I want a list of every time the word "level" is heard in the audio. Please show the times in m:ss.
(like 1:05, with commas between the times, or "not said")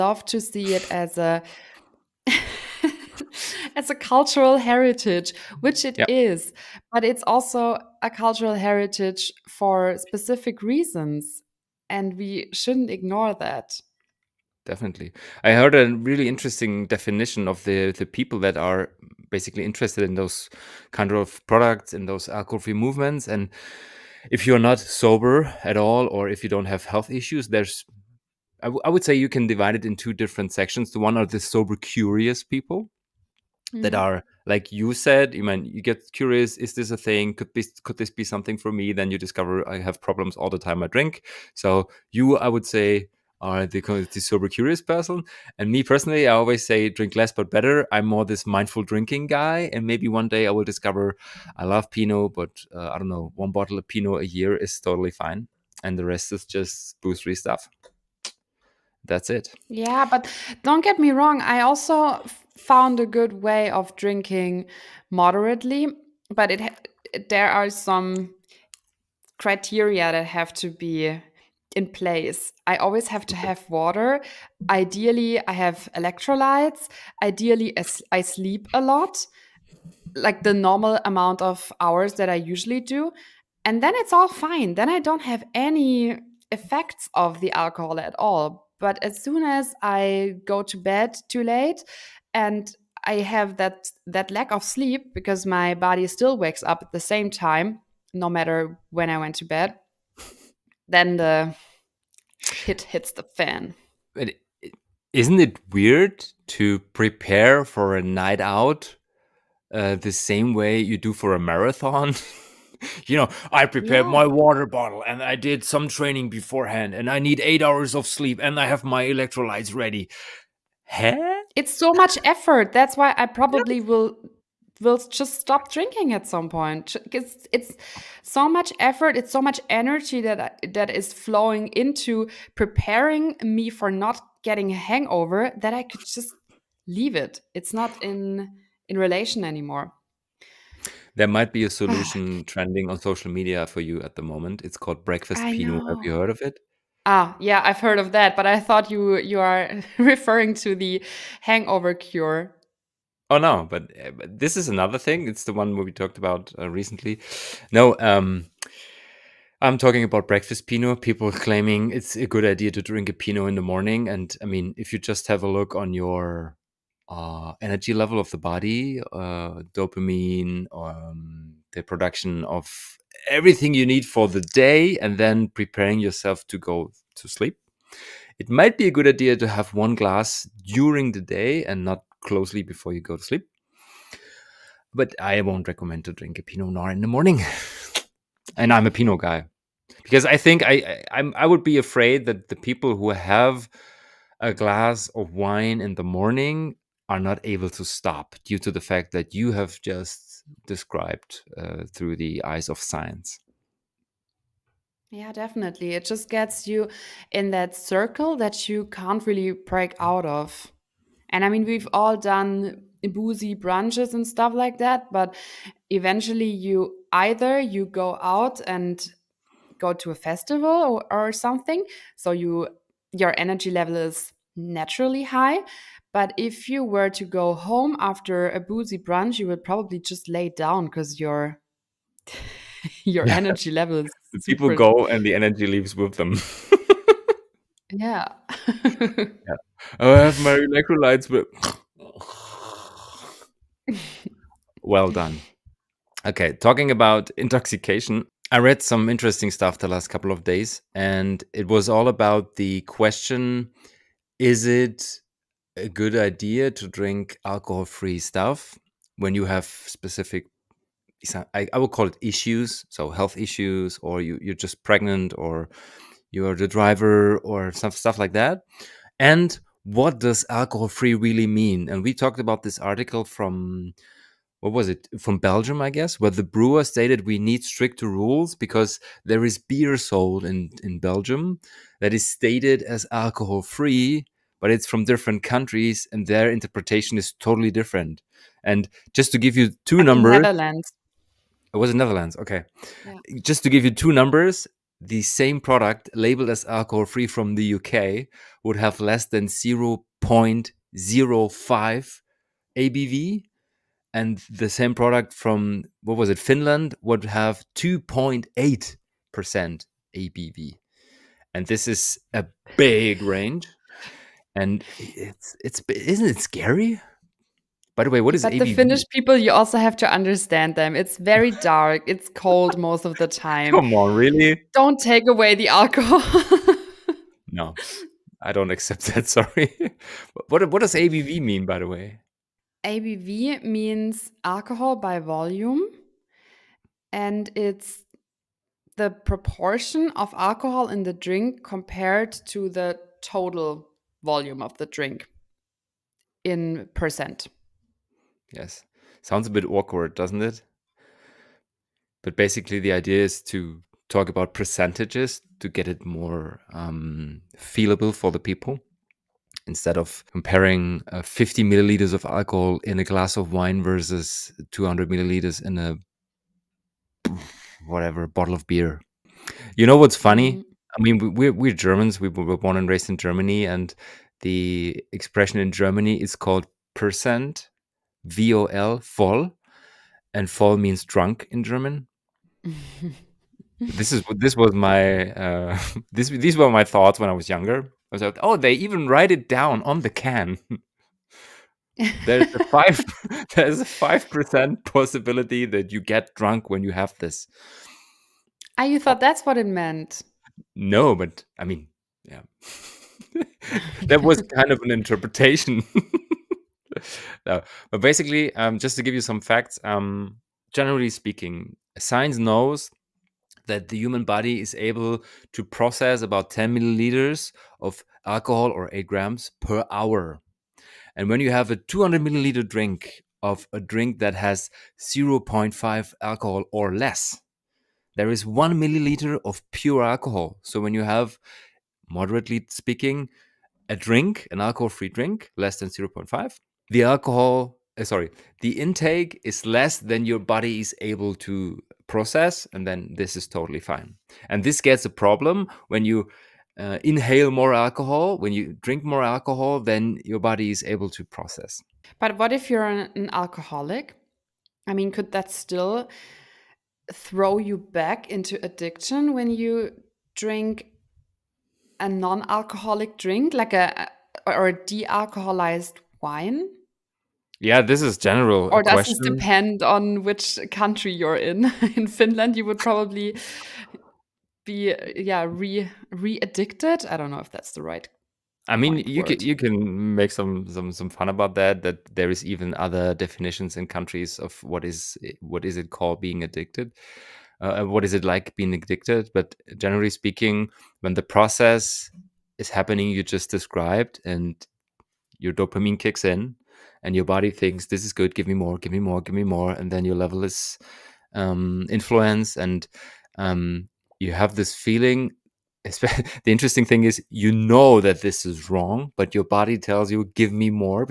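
2:47, 3:43, 3:53, 8:20.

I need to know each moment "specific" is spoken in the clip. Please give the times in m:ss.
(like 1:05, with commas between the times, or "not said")
0:09, 4:19.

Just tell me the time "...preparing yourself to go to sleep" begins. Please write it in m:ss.
2:55.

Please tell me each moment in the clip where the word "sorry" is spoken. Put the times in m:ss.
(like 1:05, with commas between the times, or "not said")
5:29, 7:18.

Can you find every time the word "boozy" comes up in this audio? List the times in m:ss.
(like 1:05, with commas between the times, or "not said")
3:33, 3:48.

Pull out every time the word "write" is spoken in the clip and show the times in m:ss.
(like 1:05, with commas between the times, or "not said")
6:29.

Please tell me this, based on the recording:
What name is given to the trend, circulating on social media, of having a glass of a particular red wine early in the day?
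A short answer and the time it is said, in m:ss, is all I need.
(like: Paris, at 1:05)
Breakfast Pinot, at 2:25.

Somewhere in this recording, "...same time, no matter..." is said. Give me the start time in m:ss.
1:36.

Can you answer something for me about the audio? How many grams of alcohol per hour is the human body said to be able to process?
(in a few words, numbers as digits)
8 grams.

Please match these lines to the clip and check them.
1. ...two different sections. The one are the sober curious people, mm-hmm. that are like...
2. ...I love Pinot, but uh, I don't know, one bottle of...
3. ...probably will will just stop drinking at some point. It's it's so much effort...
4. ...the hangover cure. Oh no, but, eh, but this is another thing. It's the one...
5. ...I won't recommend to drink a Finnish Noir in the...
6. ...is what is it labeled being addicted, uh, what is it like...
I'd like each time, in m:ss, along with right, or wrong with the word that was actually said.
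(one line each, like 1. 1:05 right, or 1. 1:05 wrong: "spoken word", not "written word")
1. 0:29 right
2. 0:51 right
3. 2:03 right
4. 2:30 right
5. 3:05 wrong: "Pinot", not "Finnish"
6. 8:04 wrong: "called", not "labeled".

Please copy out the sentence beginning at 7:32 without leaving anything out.
But what if you're an, an alcoholic?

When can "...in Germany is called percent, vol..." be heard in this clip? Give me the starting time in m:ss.
6:15.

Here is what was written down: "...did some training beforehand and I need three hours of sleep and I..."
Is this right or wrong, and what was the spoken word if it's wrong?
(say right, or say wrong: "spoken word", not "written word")
wrong: "eight", not "three".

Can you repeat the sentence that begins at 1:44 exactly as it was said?
But isn't it weird to prepare for a night out uh, the same way you do for a marathon?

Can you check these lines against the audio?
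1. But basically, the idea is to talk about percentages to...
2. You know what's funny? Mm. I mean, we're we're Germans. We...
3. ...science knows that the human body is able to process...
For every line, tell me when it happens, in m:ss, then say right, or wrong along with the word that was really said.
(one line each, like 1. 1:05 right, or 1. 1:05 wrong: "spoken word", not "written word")
1. 5:52 right
2. 6:09 right
3. 6:51 right.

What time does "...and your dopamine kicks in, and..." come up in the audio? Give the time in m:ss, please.
8:14.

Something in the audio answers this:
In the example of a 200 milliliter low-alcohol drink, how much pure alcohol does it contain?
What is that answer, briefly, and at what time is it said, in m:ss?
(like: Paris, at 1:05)
1 milliliter, at 7:08.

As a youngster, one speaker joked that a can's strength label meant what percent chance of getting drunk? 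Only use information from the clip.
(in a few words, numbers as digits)
5 percent.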